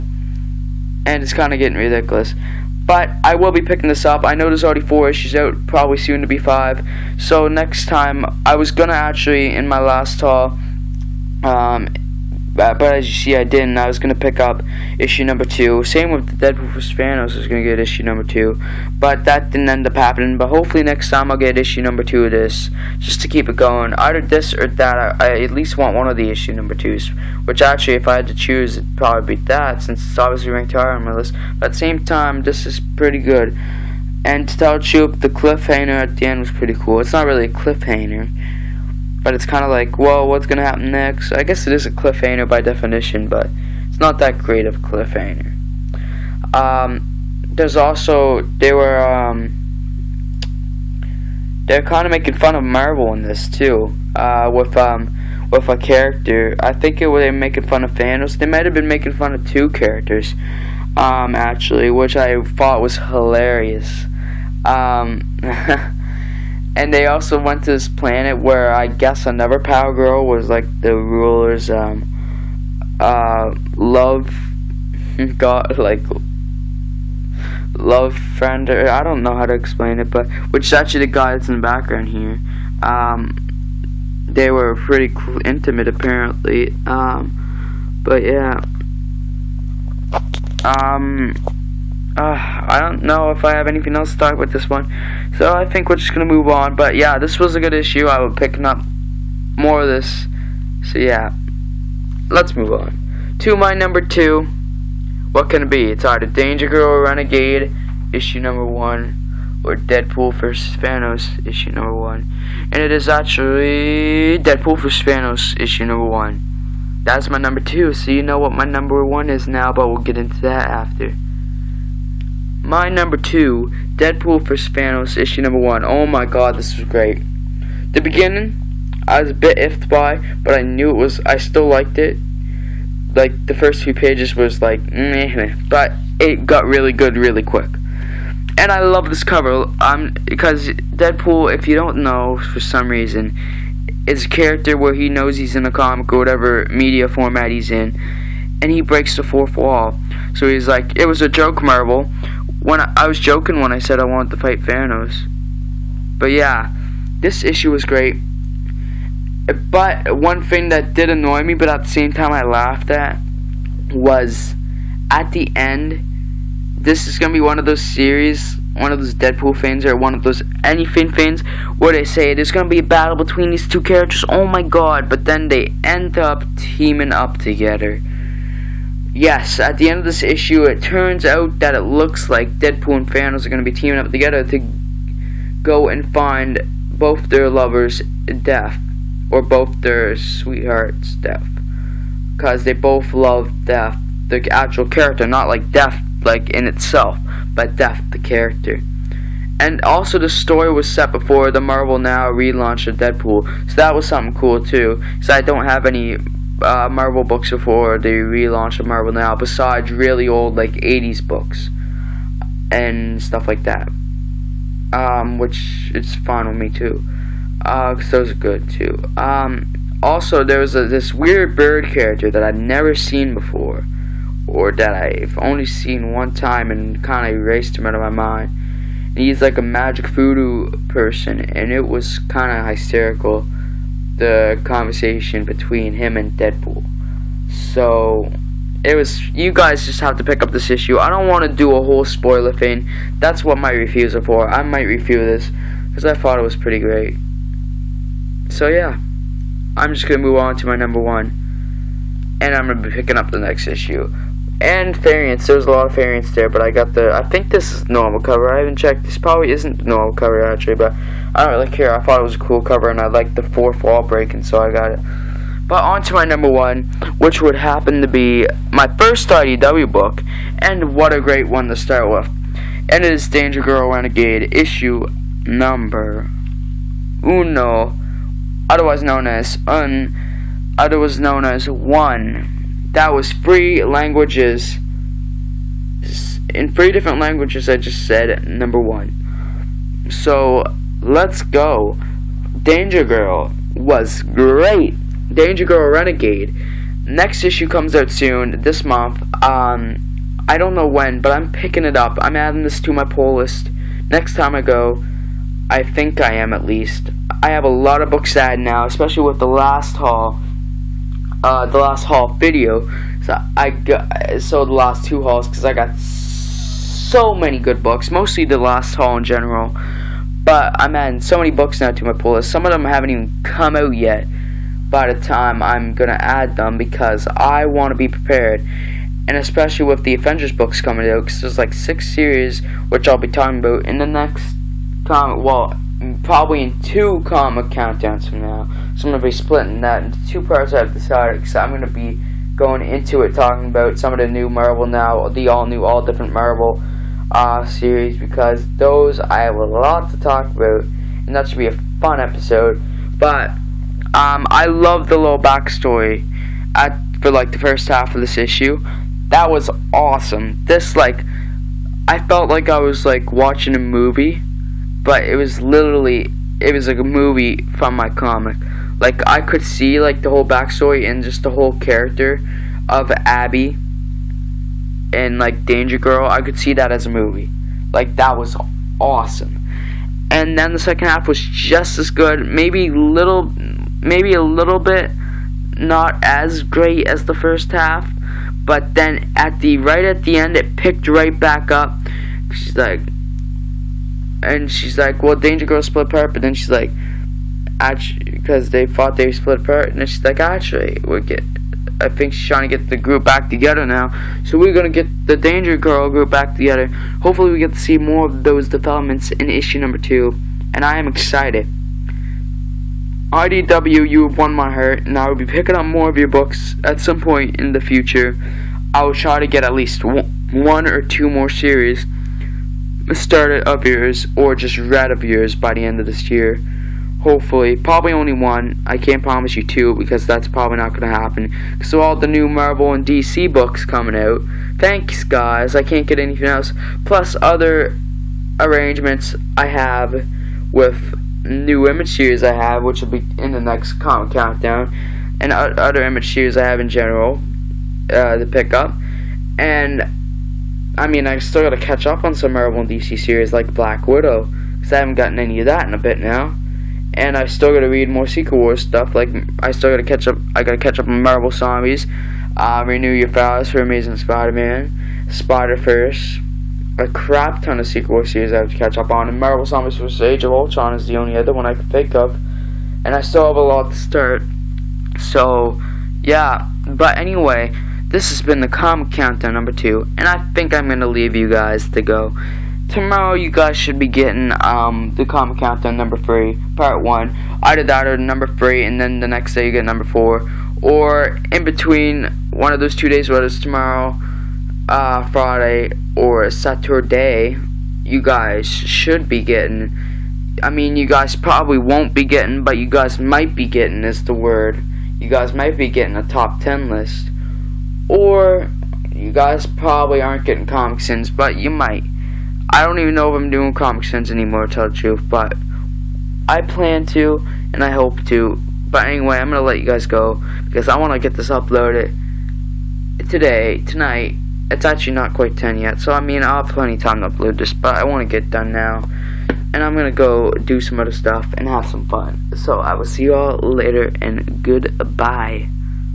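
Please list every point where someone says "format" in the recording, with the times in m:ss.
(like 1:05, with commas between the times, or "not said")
2:27.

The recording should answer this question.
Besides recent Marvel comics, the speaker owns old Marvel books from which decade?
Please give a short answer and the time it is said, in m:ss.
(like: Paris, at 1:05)
'80s, at 3:30.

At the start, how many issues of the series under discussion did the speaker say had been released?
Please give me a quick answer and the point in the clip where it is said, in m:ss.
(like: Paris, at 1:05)
4, at 0:04.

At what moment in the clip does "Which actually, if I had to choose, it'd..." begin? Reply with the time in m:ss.
0:27.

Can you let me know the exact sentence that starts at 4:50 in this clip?
So Let's Go, Danger Girl was great.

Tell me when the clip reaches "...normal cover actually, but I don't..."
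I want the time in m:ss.
4:19.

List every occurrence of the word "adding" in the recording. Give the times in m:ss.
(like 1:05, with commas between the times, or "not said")
5:02, 5:20.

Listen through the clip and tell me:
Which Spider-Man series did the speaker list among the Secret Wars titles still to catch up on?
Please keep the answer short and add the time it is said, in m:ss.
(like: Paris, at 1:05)
Renew Your Vows, at 7:42.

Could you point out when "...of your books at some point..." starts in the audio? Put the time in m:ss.
6:56.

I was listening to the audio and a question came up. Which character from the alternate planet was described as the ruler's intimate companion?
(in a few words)
Power Girl.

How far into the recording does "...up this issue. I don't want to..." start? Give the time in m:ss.
4:00.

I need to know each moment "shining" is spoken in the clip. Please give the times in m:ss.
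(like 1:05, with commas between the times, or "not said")
not said.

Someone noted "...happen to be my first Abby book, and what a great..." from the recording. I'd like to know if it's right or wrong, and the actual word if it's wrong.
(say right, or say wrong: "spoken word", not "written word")
wrong: "IDW", not "Abby".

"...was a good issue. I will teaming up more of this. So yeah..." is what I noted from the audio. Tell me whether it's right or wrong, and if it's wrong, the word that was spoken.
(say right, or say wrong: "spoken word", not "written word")
wrong: "picking", not "teaming".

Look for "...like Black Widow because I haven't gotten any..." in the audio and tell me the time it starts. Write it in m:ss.
7:33.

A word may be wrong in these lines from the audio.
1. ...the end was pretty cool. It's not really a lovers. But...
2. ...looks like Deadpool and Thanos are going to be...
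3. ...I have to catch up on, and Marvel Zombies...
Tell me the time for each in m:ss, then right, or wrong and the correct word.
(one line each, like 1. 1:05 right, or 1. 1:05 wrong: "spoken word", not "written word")
1. 0:36 wrong: "cliffhanger", not "lovers"
2. 3:01 right
3. 7:48 right.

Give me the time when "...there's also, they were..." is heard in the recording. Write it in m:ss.
0:47.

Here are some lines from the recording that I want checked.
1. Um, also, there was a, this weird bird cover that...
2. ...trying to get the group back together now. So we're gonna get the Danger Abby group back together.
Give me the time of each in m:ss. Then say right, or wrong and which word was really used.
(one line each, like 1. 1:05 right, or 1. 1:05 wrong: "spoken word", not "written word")
1. 3:39 wrong: "character", not "cover"
2. 6:42 wrong: "Girl", not "Abby".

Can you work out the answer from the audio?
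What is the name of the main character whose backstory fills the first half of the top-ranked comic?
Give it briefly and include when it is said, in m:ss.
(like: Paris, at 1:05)
Abby, at 6:13.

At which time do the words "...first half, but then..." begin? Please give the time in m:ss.
6:27.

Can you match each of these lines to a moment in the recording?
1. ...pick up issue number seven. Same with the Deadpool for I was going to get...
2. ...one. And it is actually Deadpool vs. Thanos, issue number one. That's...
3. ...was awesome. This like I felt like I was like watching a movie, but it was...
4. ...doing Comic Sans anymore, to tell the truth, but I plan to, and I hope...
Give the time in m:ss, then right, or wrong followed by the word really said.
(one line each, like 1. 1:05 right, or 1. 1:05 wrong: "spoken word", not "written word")
1. 0:14 wrong: "two", not "seven"
2. 1:51 right
3. 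5:59 right
4. 8:33 right.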